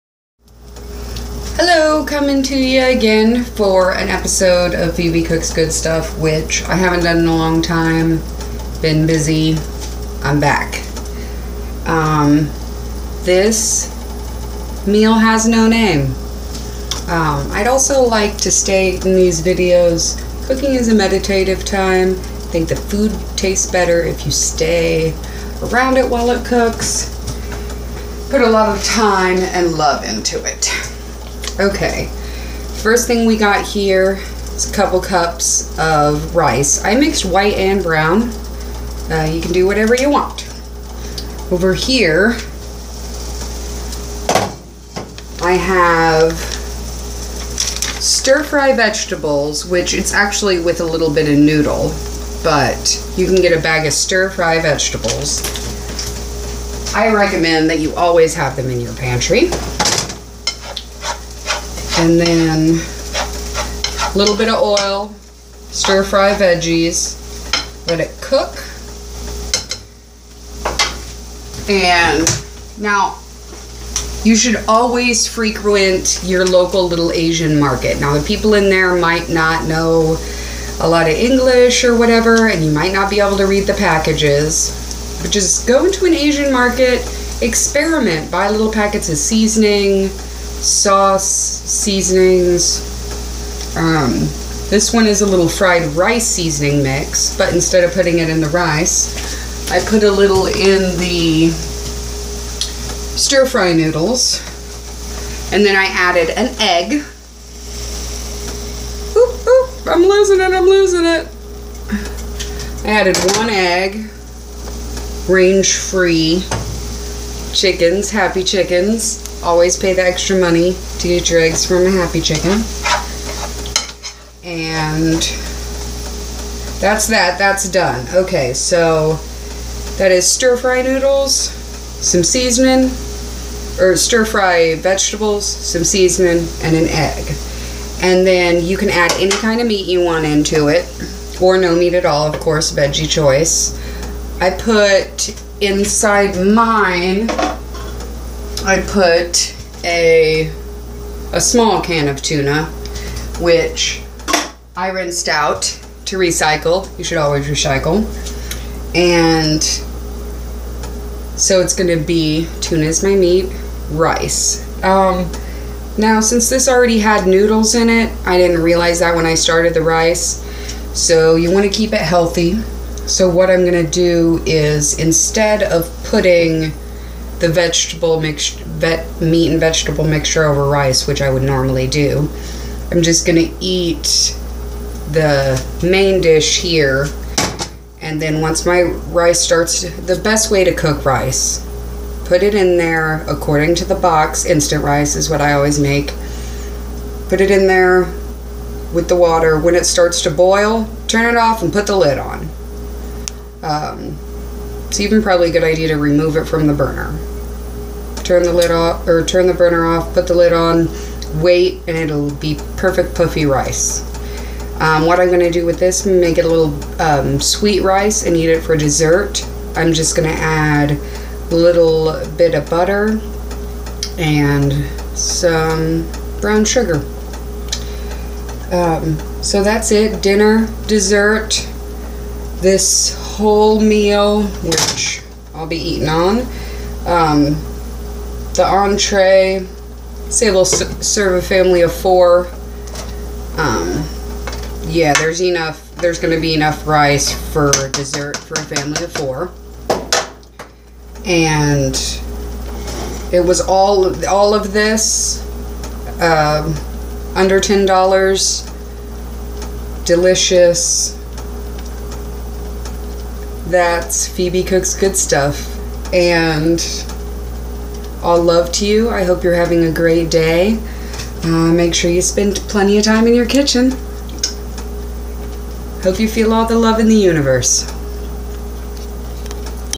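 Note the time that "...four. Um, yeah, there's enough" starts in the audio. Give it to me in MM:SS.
04:01.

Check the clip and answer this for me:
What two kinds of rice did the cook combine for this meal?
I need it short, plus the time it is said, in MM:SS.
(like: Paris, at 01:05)
white and brown, at 00:37.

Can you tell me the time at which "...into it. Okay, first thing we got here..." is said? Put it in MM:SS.
00:30.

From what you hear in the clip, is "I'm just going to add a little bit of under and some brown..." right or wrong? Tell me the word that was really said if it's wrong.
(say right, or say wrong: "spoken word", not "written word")
wrong: "butter", not "under".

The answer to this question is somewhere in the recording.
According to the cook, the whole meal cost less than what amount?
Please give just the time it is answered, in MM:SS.
04:17.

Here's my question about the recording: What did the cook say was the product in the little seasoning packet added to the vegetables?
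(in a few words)
fried rice seasoning mix.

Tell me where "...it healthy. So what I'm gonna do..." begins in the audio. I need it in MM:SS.
02:51.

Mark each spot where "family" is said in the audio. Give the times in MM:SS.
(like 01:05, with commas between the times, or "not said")
04:01, 04:08.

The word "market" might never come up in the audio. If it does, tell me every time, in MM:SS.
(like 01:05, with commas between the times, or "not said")
01:17, 01:26.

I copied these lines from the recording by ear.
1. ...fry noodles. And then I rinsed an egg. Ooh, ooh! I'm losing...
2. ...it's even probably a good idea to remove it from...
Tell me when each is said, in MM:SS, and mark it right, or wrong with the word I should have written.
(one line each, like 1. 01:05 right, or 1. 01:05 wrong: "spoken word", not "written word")
1. 01:43 wrong: "added", not "rinsed"
2. 03:24 right.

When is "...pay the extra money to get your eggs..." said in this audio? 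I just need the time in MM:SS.
01:59.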